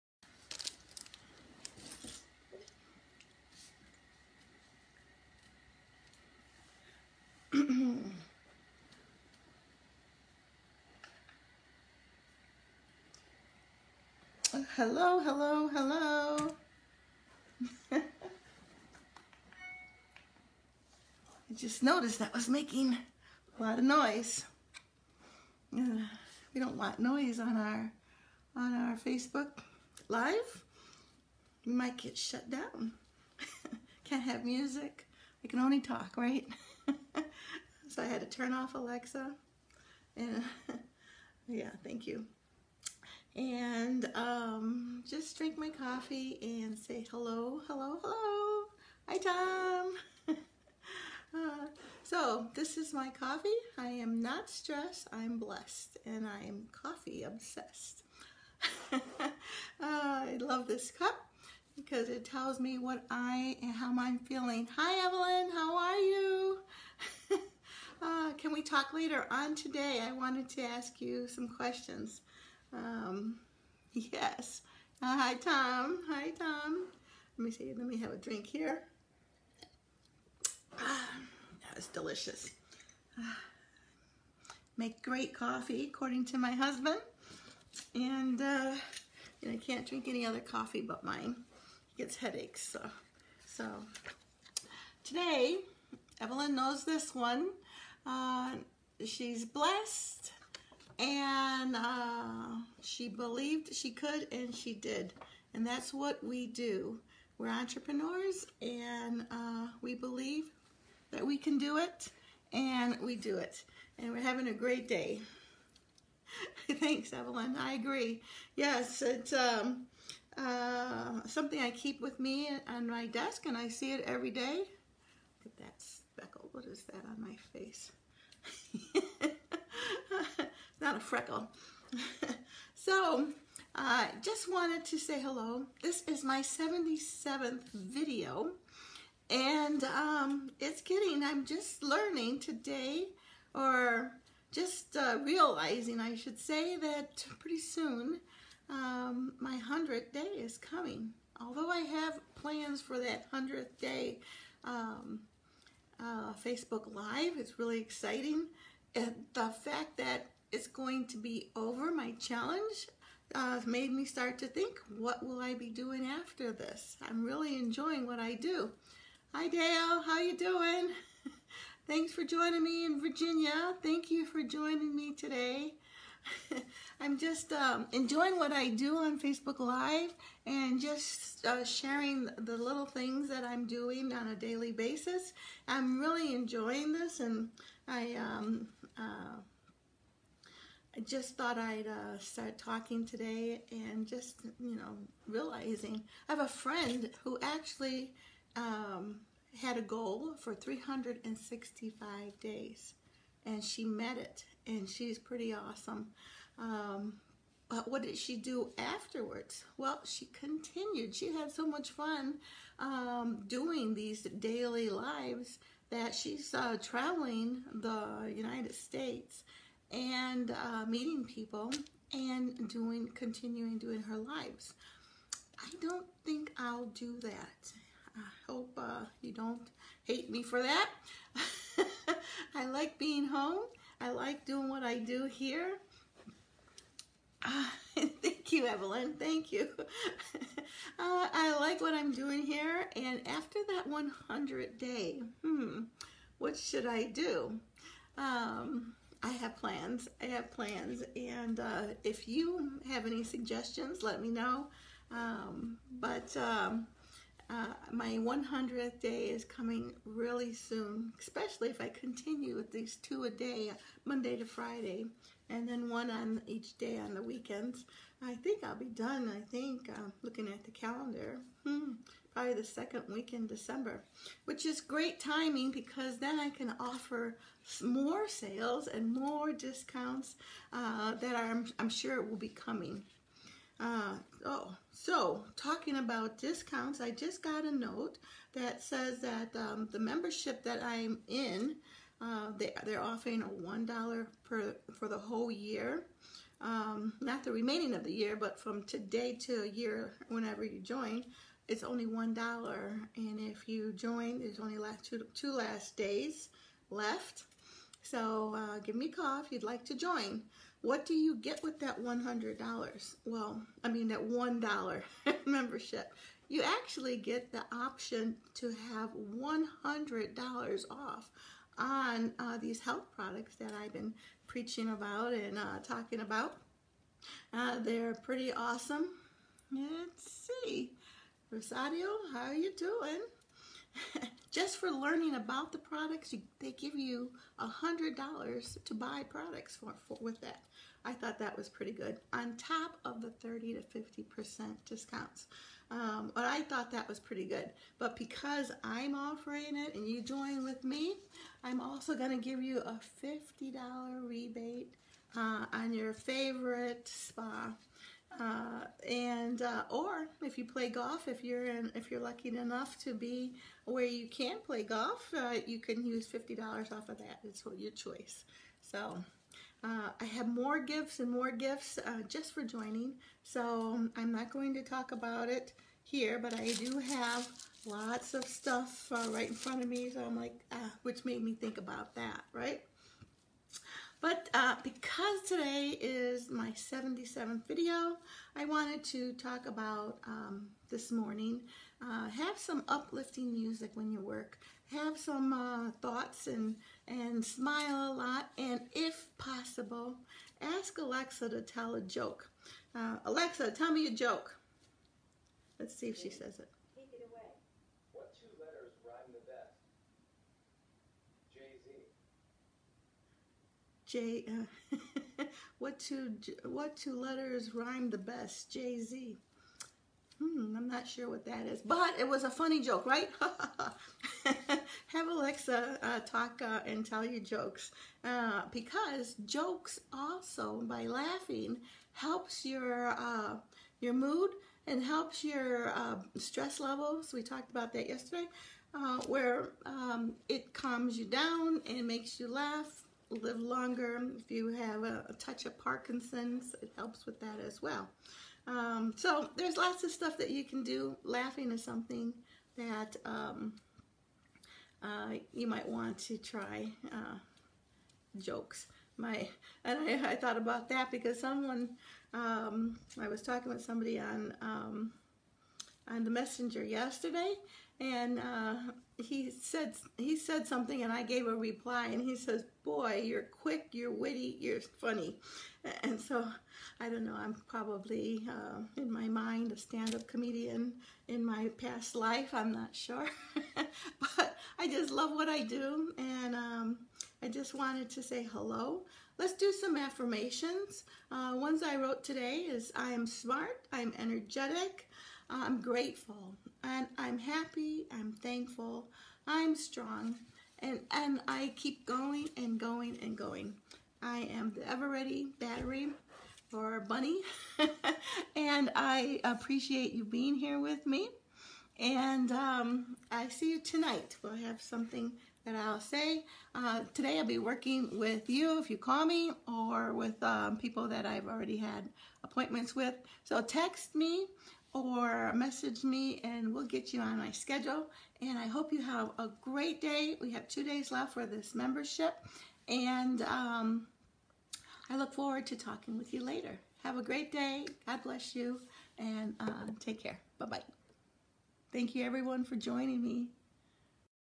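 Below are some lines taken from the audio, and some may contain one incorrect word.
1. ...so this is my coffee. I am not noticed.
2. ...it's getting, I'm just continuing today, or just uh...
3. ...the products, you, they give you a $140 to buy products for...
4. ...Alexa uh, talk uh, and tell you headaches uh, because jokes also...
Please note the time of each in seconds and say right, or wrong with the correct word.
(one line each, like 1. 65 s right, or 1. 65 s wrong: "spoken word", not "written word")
1. 52 s wrong: "stressed", not "noticed"
2. 140 s wrong: "learning", not "continuing"
3. 335 s wrong: "100", not "140"
4. 425 s wrong: "jokes", not "headaches".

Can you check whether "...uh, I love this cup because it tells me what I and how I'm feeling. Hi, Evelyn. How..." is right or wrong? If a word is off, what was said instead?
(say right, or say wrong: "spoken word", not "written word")
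right.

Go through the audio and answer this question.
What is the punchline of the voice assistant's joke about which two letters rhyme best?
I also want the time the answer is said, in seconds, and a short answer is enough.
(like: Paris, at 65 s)
Jay-Z, at 411 s.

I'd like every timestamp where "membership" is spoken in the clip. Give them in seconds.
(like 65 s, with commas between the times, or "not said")
289 s, 315 s, 531 s.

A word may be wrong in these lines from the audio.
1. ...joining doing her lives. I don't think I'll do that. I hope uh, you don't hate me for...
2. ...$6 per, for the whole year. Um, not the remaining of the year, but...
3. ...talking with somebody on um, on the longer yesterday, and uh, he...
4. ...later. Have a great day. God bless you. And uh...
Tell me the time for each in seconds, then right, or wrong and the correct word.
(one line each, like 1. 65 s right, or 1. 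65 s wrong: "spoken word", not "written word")
1. 223 s wrong: "continuing", not "joining"
2. 293 s wrong: "1", not "6"
3. 463 s wrong: "messenger", not "longer"
4. 536 s right.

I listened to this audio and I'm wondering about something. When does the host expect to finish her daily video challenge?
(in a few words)
second week in December.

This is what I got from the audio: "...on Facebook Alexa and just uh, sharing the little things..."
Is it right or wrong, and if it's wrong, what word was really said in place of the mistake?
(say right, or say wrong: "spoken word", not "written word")
wrong: "Live", not "Alexa".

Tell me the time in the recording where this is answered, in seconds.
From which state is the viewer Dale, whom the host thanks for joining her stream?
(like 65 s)
172 s.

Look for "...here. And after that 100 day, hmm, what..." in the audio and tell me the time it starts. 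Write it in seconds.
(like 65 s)
242 s.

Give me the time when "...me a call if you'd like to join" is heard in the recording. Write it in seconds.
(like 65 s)
308 s.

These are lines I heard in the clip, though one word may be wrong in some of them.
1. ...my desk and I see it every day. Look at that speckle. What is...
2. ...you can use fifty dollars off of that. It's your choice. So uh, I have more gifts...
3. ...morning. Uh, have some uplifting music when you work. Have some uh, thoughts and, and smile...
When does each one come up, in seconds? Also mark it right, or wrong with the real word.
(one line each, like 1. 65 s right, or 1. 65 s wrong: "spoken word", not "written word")
1. 122 s right
2. 365 s right
3. 391 s right.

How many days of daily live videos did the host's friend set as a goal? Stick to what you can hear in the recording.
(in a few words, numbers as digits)
365.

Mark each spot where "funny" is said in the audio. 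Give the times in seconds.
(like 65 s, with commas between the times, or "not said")
422 s, 474 s.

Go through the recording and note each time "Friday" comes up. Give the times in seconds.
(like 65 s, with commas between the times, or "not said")
264 s.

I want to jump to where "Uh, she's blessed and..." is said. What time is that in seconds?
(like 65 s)
98 s.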